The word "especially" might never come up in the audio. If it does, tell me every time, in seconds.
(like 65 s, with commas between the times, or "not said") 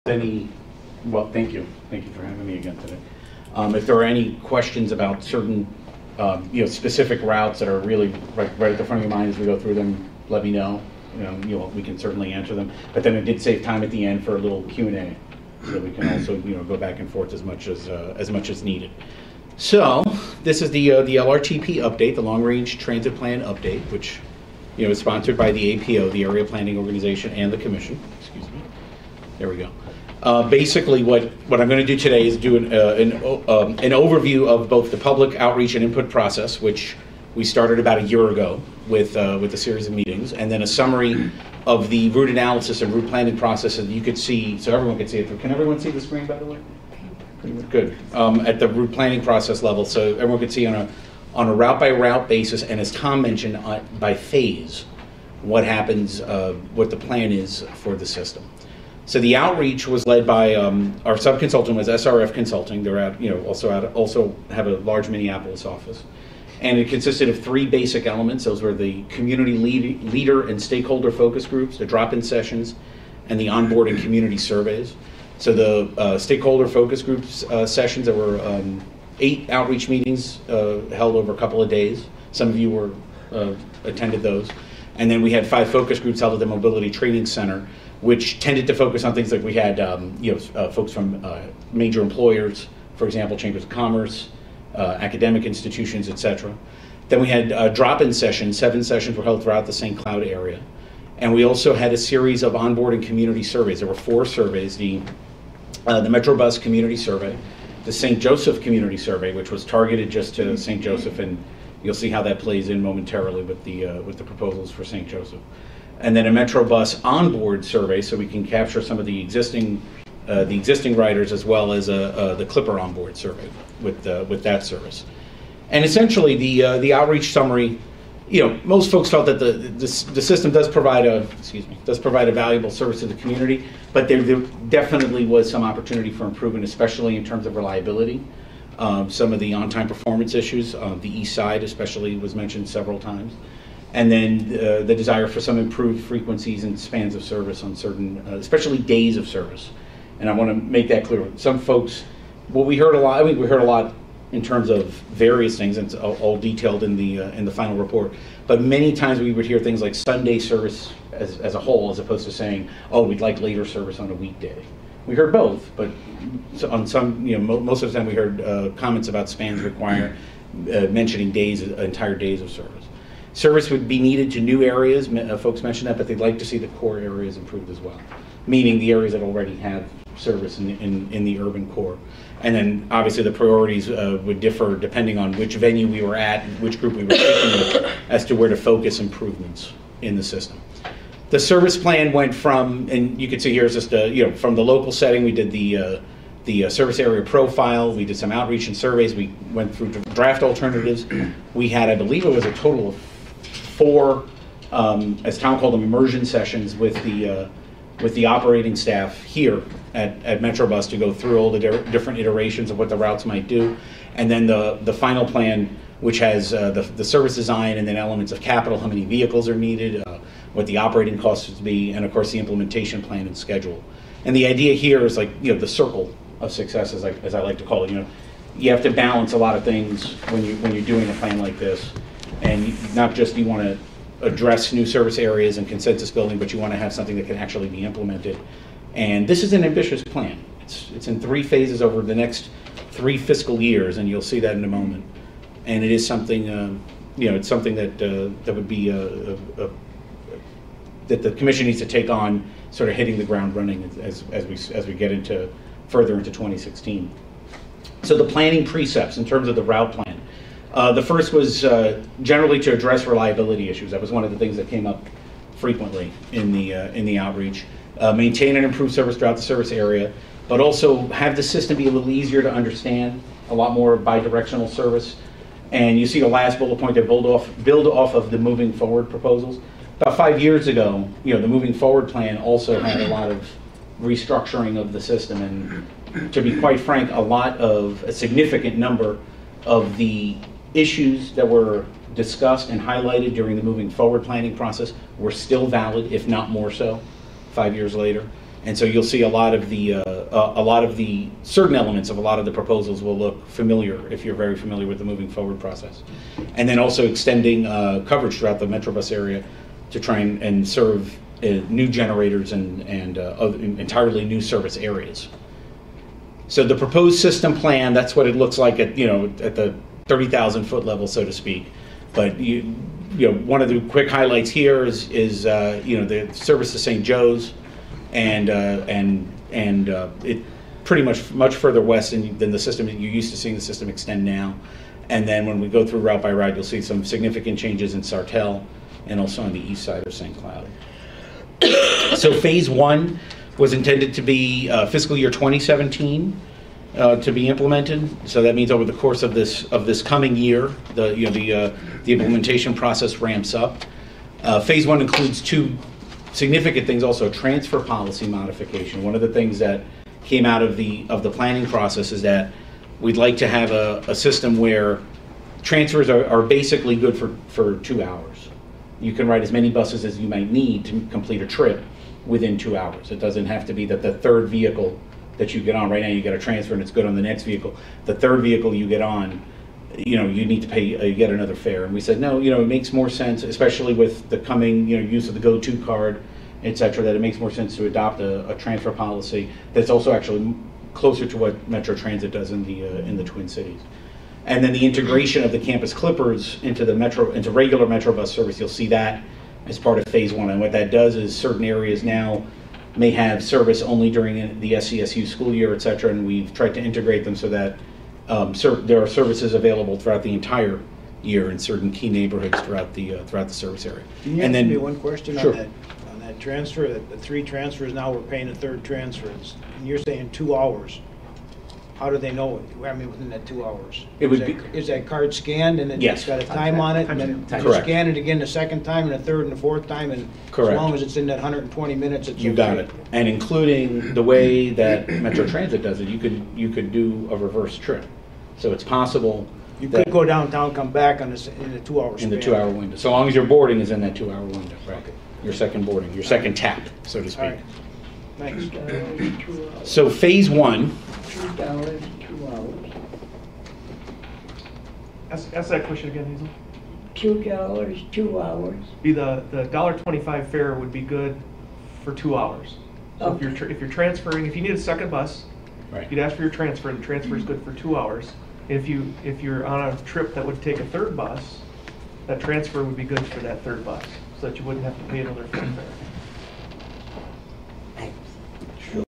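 136 s, 141 s, 148 s, 383 s.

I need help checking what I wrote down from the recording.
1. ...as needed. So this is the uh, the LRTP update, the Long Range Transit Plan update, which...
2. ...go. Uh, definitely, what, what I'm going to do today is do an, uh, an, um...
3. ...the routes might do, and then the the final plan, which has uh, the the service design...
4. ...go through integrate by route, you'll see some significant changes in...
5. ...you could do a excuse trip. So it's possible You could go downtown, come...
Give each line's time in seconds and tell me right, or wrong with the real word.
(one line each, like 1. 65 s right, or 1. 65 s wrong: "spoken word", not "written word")
1. 18 s right
2. 29 s wrong: "basically", not "definitely"
3. 212 s right
4. 335 s wrong: "route", not "integrate"
5. 436 s wrong: "reverse", not "excuse".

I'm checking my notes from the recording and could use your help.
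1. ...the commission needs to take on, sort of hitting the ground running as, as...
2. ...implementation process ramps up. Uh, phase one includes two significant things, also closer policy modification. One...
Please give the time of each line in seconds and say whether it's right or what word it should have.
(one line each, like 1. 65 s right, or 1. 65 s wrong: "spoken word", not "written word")
1. 251 s right
2. 352 s wrong: "transfer", not "closer".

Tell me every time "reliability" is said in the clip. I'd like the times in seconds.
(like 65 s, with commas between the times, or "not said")
137 s, 263 s.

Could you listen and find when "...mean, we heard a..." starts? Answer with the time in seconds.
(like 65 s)
153 s.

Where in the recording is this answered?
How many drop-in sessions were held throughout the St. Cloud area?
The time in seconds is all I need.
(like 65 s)
98 s.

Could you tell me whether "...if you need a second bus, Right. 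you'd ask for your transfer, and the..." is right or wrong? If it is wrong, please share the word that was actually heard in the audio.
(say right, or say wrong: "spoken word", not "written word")
right.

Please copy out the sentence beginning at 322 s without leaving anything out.
But you, you know, one of the quick highlights here is, is uh, you know, the service to St.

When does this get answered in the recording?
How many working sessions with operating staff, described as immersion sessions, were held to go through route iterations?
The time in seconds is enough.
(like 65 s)
202 s.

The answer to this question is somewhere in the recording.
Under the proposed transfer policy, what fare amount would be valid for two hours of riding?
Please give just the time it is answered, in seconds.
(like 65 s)
459 s.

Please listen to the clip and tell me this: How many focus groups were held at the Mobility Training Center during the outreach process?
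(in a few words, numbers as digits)
5.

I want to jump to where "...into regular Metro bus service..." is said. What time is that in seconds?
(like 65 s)
397 s.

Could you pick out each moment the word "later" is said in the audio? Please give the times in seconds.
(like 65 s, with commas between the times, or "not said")
163 s, 297 s.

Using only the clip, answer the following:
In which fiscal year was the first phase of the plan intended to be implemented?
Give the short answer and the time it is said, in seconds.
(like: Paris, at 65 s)
2017, at 344 s.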